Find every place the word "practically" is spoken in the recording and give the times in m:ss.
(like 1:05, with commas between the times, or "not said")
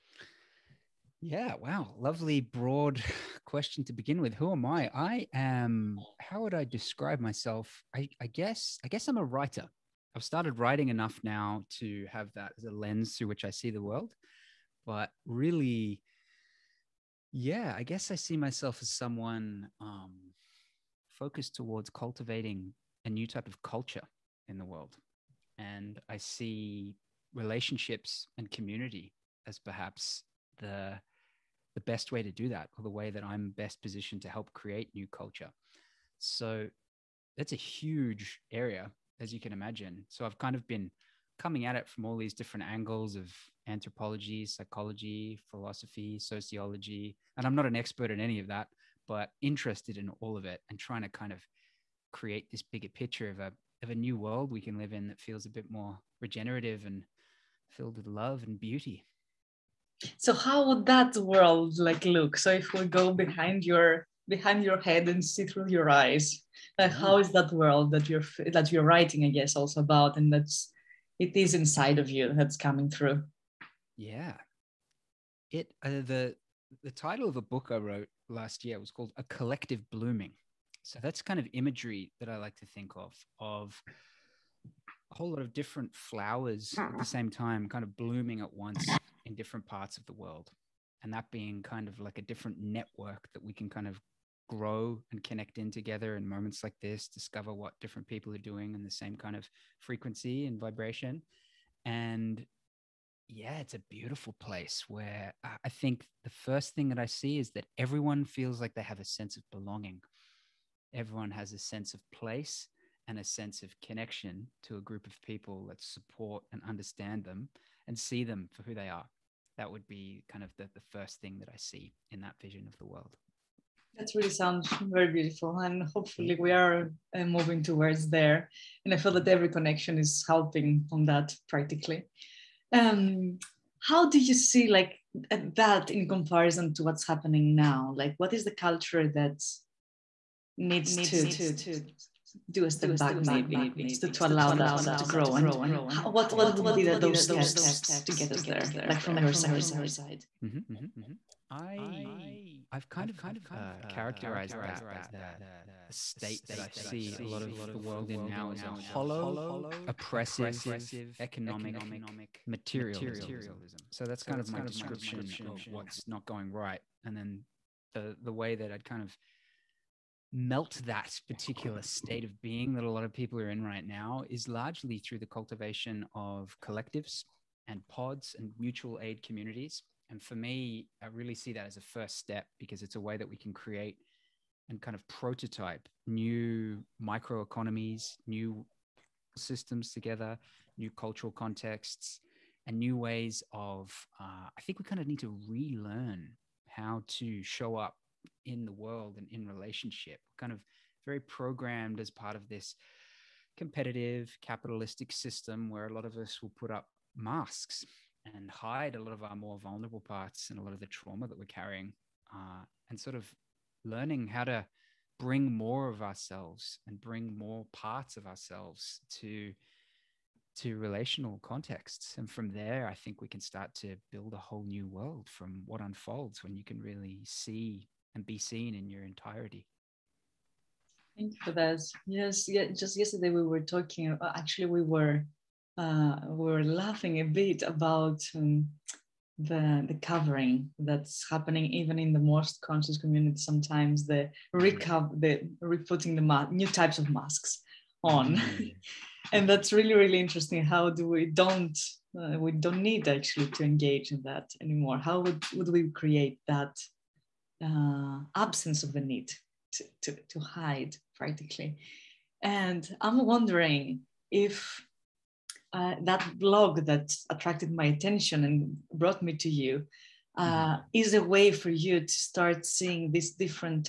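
2:11, 4:21.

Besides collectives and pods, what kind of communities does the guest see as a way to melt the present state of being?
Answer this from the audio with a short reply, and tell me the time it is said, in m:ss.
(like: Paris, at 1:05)
mutual aid communities, at 2:58.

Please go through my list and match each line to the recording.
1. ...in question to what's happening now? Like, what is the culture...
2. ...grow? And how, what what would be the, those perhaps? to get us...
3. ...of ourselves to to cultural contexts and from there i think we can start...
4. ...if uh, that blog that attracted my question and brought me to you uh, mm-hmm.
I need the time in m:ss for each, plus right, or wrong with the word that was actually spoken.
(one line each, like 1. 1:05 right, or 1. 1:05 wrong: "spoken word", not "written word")
1. 2:15 wrong: "comparison", not "question"
2. 2:25 wrong: "steps", not "perhaps"
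3. 3:38 wrong: "relational", not "cultural"
4. 4:24 wrong: "attention", not "question".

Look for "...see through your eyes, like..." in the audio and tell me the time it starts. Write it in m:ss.
1:05.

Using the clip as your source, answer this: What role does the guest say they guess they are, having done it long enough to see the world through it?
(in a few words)
a writer.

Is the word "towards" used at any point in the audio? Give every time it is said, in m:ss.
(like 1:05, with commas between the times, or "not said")
0:21, 2:07.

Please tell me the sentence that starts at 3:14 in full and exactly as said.
Uh, I think we kind of need to relearn how to show up in the world and in relationship.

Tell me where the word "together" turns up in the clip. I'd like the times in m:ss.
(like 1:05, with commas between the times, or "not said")
1:35, 3:09.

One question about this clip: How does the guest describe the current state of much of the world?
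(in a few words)
hollow oppressive economic materialism.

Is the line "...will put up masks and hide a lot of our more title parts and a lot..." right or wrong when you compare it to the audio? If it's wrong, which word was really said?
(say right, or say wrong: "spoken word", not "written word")
wrong: "vulnerable", not "title".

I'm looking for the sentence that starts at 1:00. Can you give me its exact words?
So how would that world like look?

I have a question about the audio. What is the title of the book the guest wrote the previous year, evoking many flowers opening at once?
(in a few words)
A Collective Blooming.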